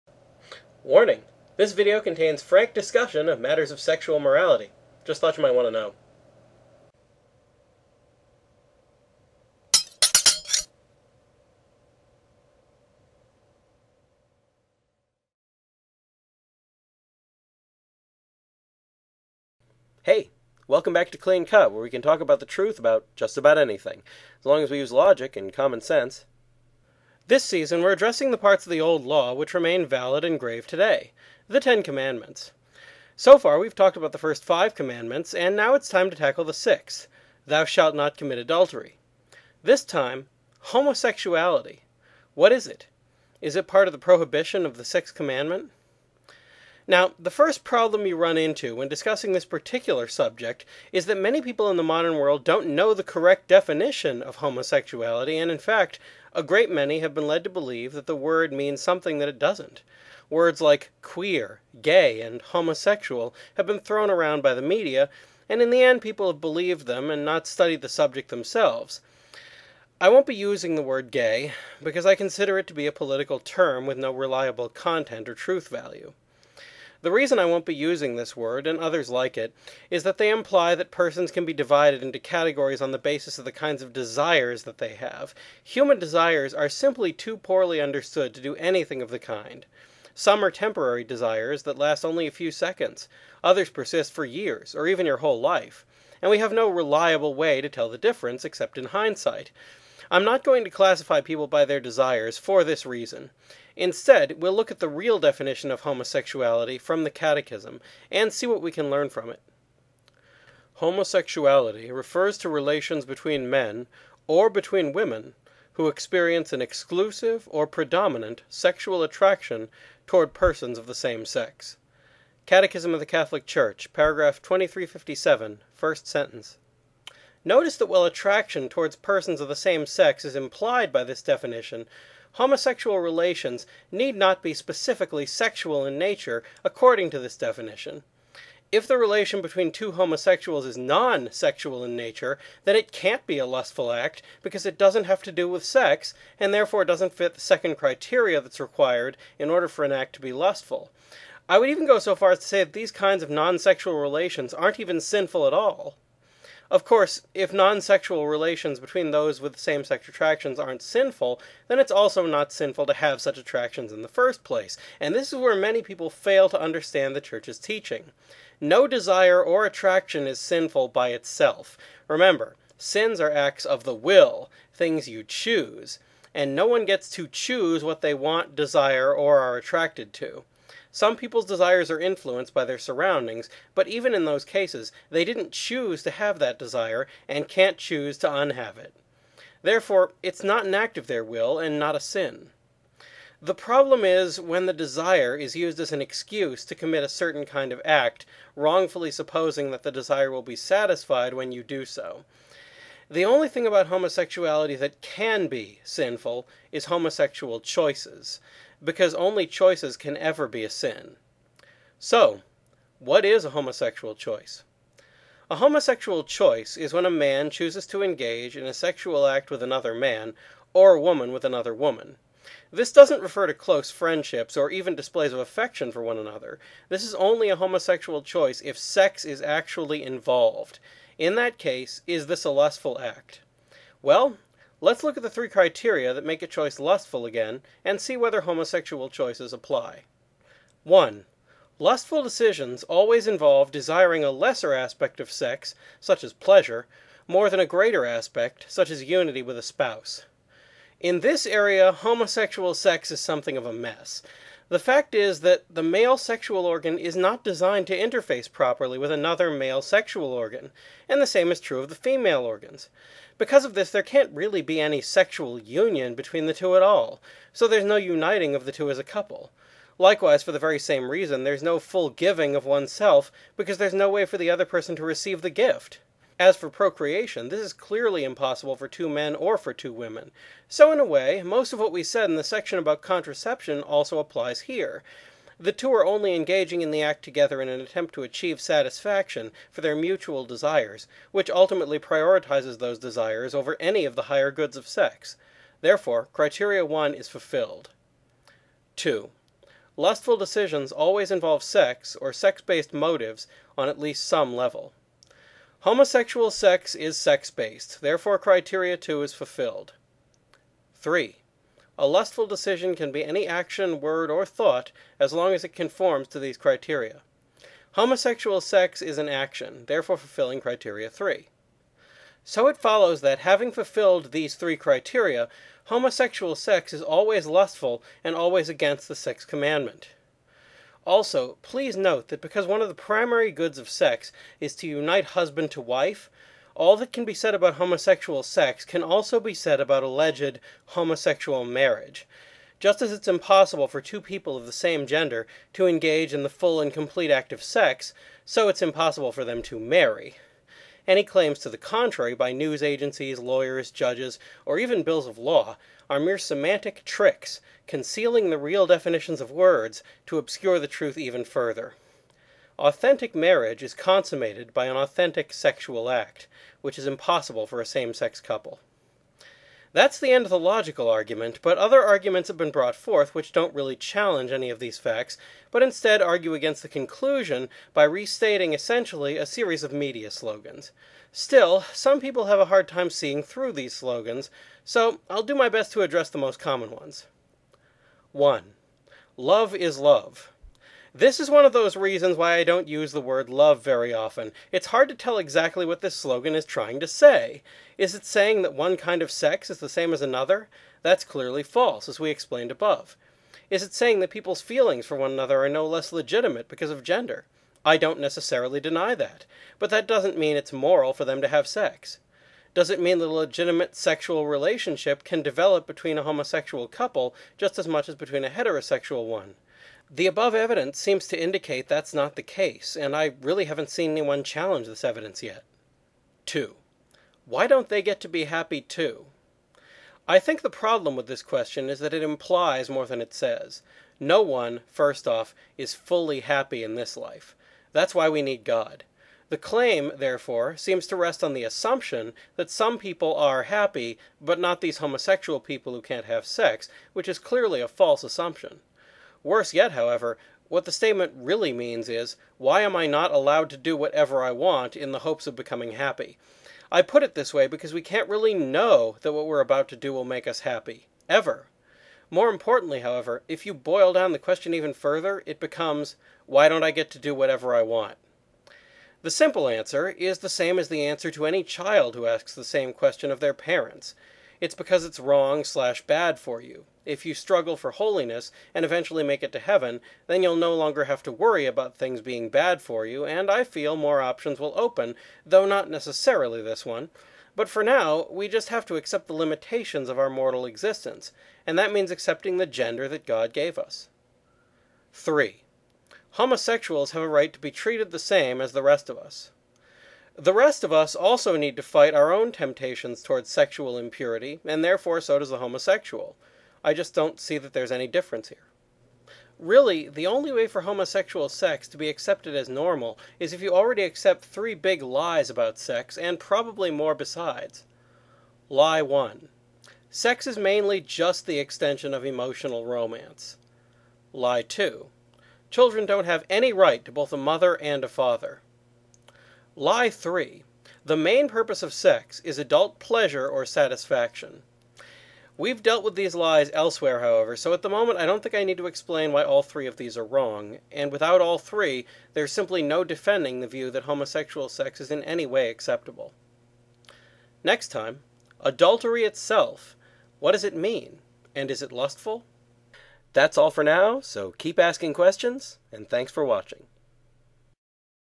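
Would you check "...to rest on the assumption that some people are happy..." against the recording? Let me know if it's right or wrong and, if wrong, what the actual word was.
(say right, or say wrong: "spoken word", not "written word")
right.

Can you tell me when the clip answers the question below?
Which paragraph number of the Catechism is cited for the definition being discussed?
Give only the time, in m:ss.
2:04.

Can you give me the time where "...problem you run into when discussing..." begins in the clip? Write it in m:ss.
0:47.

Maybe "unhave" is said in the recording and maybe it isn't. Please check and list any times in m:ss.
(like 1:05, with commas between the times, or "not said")
3:08.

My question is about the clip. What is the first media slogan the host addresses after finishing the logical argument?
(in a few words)
Love is love.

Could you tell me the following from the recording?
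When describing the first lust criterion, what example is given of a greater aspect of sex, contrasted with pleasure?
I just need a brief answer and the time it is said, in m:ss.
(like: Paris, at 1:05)
unity with a spouse, at 4:09.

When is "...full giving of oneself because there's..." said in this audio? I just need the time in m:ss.
4:31.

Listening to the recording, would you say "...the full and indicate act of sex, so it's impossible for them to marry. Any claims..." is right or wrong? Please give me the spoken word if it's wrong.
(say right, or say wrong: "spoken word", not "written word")
wrong: "complete", not "indicate".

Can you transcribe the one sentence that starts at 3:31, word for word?
So, what is a homosexual choice?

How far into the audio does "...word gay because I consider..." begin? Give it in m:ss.
1:10.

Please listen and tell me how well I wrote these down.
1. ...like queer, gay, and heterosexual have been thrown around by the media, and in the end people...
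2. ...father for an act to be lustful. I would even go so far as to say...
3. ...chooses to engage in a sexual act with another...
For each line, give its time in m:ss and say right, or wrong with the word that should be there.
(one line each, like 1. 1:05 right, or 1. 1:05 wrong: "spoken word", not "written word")
1. 1:00 wrong: "homosexual", not "heterosexual"
2. 2:29 wrong: "order", not "father"
3. 3:37 right.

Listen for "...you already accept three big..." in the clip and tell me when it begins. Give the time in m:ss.
8:33.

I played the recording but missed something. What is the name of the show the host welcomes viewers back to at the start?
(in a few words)
Clean Cut.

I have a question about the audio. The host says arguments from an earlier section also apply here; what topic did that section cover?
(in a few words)
contraception.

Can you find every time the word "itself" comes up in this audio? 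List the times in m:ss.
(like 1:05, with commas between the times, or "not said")
2:51, 9:09.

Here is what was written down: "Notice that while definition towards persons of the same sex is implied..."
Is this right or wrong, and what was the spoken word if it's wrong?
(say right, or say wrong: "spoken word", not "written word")
wrong: "attraction", not "definition".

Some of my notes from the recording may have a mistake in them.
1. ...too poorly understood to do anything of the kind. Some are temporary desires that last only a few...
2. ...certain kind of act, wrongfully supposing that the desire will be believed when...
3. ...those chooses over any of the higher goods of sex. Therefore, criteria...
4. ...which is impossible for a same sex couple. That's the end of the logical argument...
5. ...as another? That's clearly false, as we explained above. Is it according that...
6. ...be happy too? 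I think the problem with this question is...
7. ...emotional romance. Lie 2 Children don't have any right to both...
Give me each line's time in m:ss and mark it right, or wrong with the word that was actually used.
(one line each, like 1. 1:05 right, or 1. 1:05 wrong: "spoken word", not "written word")
1. 1:27 right
2. 3:17 wrong: "satisfied", not "believed"
3. 4:52 wrong: "desires", not "chooses"
4. 6:06 right
5. 6:40 wrong: "saying", not "according"
6. 7:08 right
7. 8:42 right.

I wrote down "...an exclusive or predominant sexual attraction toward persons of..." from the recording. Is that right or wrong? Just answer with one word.
right.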